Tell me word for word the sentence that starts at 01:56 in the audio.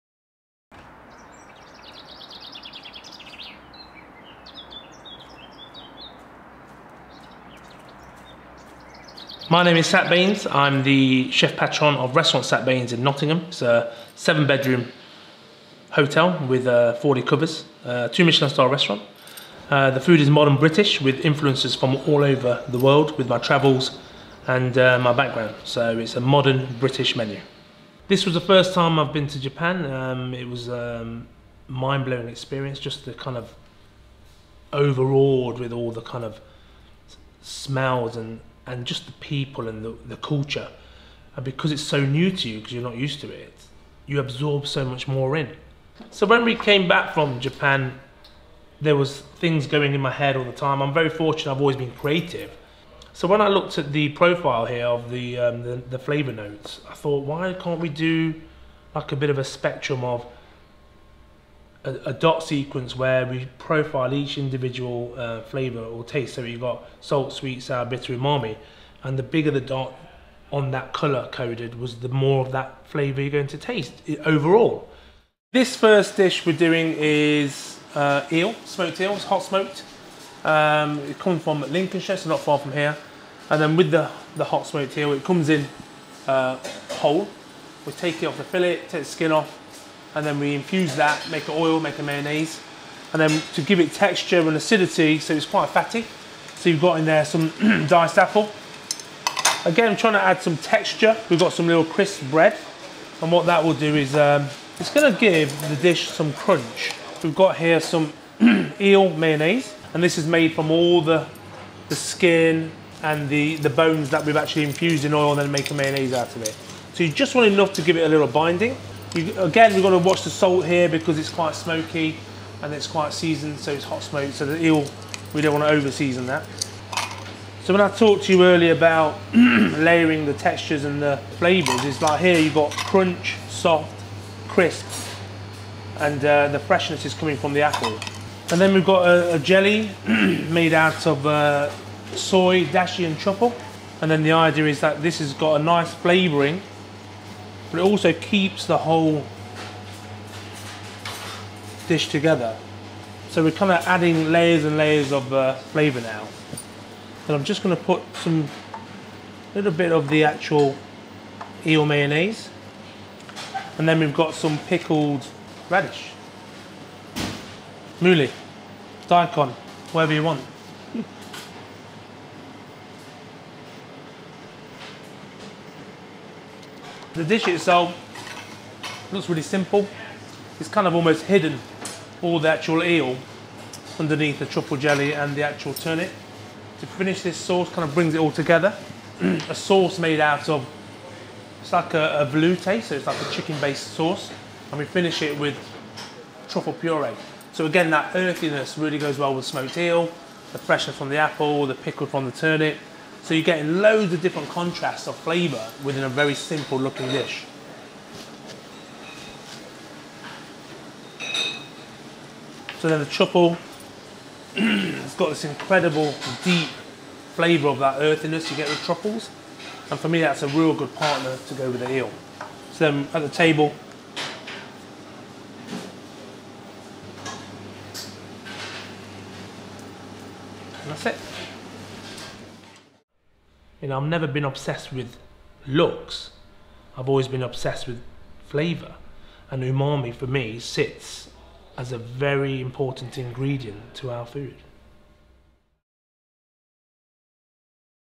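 So you just want enough to give it a little binding.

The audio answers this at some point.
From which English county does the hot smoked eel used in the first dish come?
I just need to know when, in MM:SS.
01:21.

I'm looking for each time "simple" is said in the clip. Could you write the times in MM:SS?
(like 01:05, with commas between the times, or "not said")
02:59, 03:26.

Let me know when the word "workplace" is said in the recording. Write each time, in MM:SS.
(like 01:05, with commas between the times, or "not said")
not said.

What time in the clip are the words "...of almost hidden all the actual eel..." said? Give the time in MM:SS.
03:00.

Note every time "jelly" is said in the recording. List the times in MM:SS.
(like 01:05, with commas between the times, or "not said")
02:19, 03:04.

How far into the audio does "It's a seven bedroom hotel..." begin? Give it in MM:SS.
00:13.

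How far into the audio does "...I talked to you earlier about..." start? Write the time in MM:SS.
02:07.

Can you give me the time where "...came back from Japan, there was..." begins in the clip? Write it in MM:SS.
00:46.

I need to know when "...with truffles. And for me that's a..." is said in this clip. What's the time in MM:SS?
03:38.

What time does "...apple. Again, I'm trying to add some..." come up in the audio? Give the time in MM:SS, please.
01:38.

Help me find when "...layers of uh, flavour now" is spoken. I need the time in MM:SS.
02:34.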